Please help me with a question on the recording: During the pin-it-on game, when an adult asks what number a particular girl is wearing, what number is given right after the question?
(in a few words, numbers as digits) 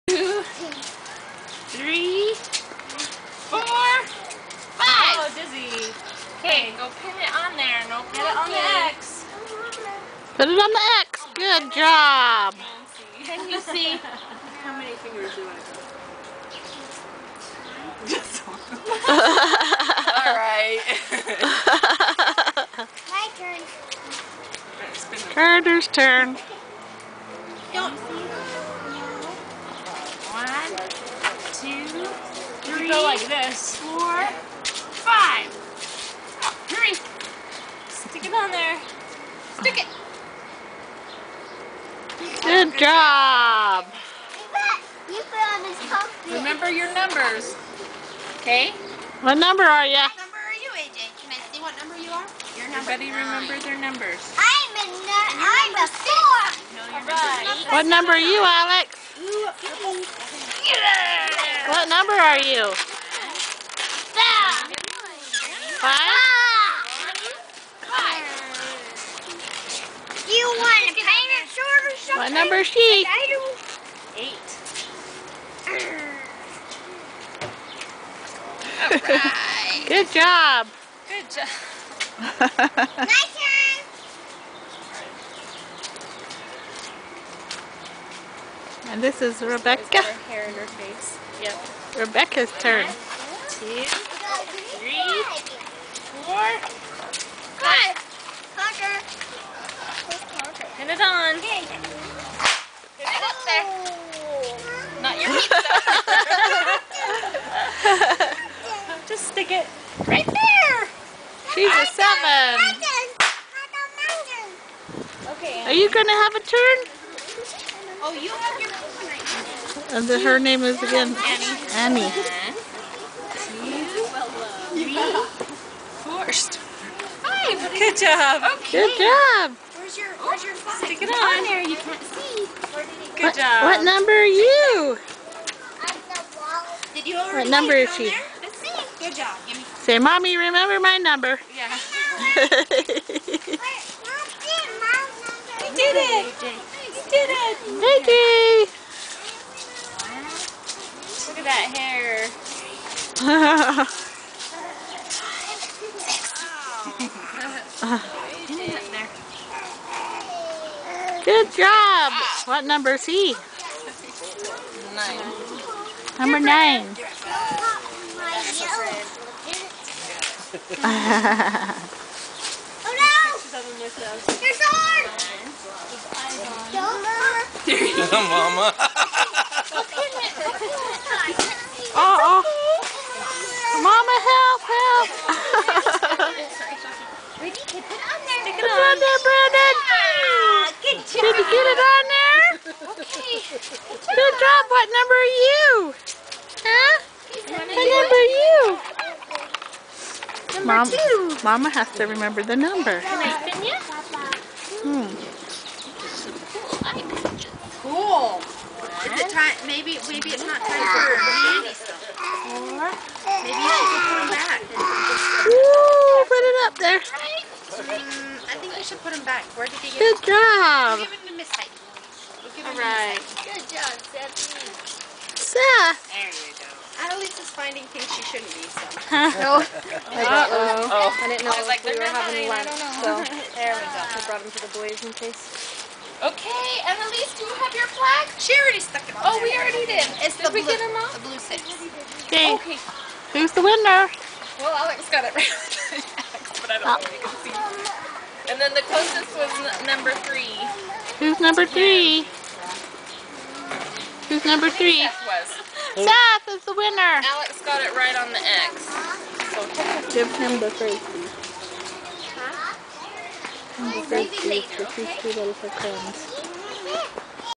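8.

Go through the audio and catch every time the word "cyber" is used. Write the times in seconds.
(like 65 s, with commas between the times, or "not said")
not said.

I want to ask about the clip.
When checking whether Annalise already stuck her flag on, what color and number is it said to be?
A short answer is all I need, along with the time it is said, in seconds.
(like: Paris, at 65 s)
blue 6, at 241 s.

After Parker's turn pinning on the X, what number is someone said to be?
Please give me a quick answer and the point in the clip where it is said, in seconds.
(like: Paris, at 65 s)
7, at 111 s.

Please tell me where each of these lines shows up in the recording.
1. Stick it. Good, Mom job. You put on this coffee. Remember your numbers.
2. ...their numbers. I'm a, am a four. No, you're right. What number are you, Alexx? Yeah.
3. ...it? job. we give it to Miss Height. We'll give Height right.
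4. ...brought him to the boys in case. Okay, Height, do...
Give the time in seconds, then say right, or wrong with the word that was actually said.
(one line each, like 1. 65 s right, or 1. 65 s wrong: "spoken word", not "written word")
1. 39 s wrong: "Good", not "Mom"
2. 53 s right
3. 220 s wrong: "All", not "Height"
4. 234 s wrong: "Annalise", not "Height".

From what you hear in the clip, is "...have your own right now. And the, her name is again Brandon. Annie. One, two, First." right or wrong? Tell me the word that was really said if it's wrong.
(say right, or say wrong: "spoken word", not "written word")
wrong: "Annie", not "Brandon".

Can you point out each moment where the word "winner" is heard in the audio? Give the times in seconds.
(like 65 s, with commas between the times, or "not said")
243 s, 256 s.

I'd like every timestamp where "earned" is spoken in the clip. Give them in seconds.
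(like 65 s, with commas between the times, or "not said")
not said.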